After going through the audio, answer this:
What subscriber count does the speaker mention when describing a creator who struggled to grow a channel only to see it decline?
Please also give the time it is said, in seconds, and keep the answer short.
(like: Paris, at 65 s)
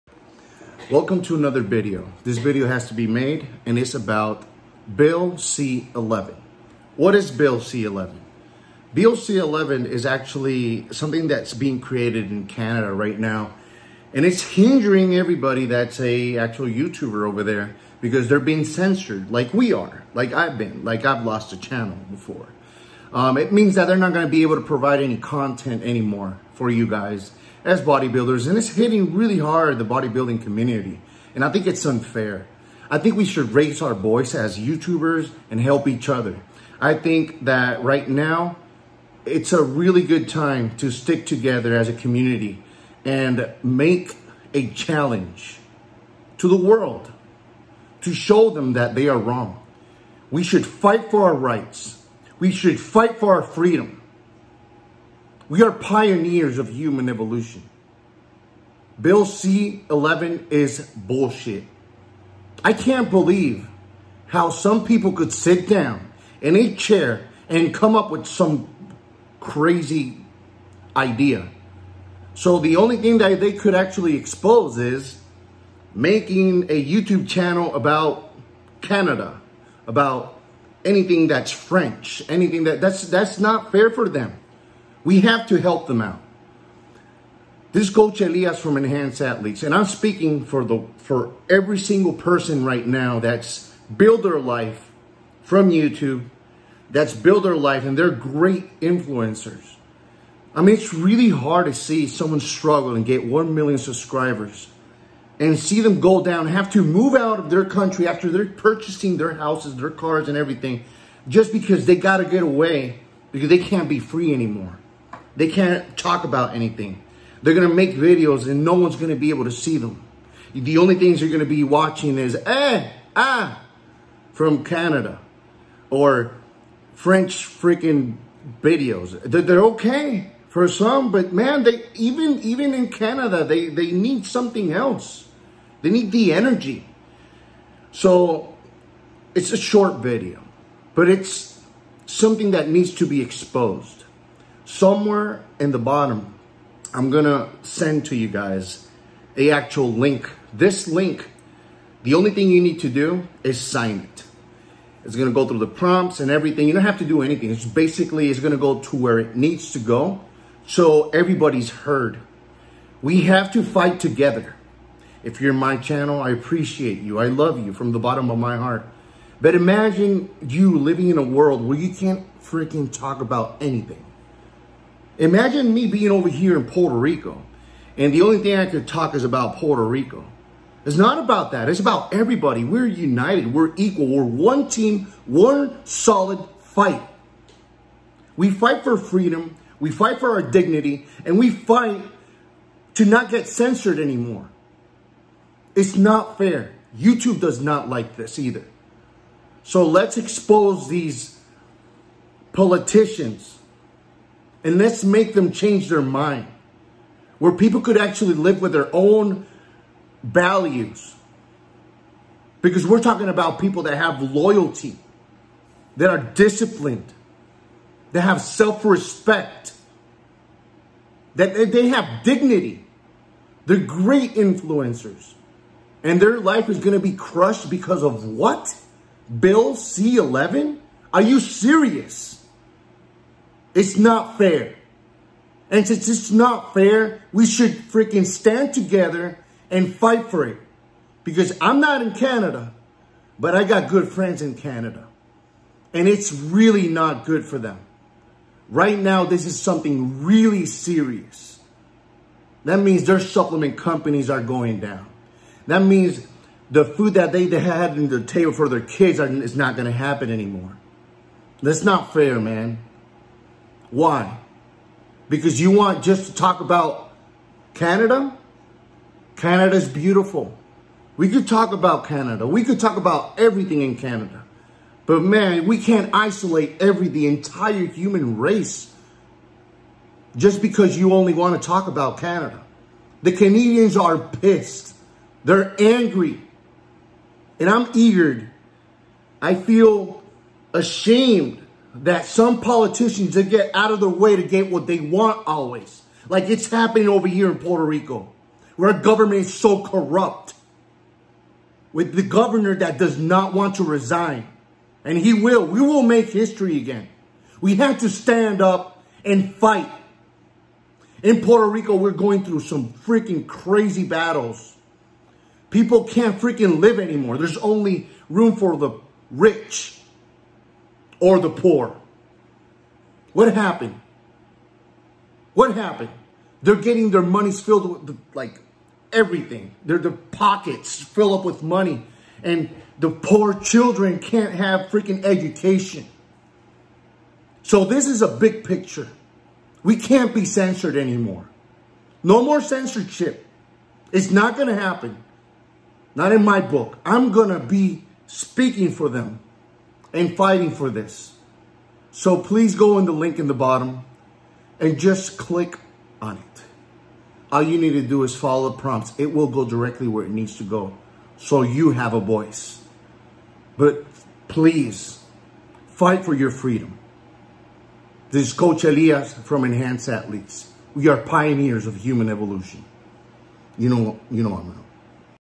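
1 million, at 103 s.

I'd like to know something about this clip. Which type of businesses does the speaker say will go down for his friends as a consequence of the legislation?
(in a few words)
supplement companies.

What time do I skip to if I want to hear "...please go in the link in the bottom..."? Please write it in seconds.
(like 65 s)
352 s.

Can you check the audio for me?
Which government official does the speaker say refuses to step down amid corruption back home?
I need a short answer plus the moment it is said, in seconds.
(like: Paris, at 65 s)
the governor, at 302 s.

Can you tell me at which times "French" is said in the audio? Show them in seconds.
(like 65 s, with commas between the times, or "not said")
81 s, 126 s.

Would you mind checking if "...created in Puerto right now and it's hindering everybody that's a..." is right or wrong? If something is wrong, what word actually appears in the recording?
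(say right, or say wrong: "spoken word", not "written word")
wrong: "Canada", not "Puerto".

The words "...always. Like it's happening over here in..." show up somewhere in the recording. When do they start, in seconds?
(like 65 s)
295 s.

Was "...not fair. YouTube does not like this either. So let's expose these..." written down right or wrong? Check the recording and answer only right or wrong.
right.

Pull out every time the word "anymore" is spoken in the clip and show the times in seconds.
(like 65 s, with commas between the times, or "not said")
25 s, 114 s, 193 s, 260 s, 316 s, 340 s.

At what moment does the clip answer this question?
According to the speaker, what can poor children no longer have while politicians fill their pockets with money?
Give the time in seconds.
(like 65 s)
335 s.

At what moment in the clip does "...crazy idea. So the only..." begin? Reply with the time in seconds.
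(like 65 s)
69 s.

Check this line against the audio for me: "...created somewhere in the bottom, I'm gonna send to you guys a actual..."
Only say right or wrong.
wrong.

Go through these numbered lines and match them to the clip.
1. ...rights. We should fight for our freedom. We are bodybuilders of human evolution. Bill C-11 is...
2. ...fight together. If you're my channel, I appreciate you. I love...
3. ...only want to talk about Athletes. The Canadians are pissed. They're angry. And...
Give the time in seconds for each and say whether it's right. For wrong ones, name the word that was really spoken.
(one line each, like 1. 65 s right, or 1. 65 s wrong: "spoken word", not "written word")
1. 51 s wrong: "pioneers", not "bodybuilders"
2. 163 s right
3. 281 s wrong: "Canada", not "Athletes".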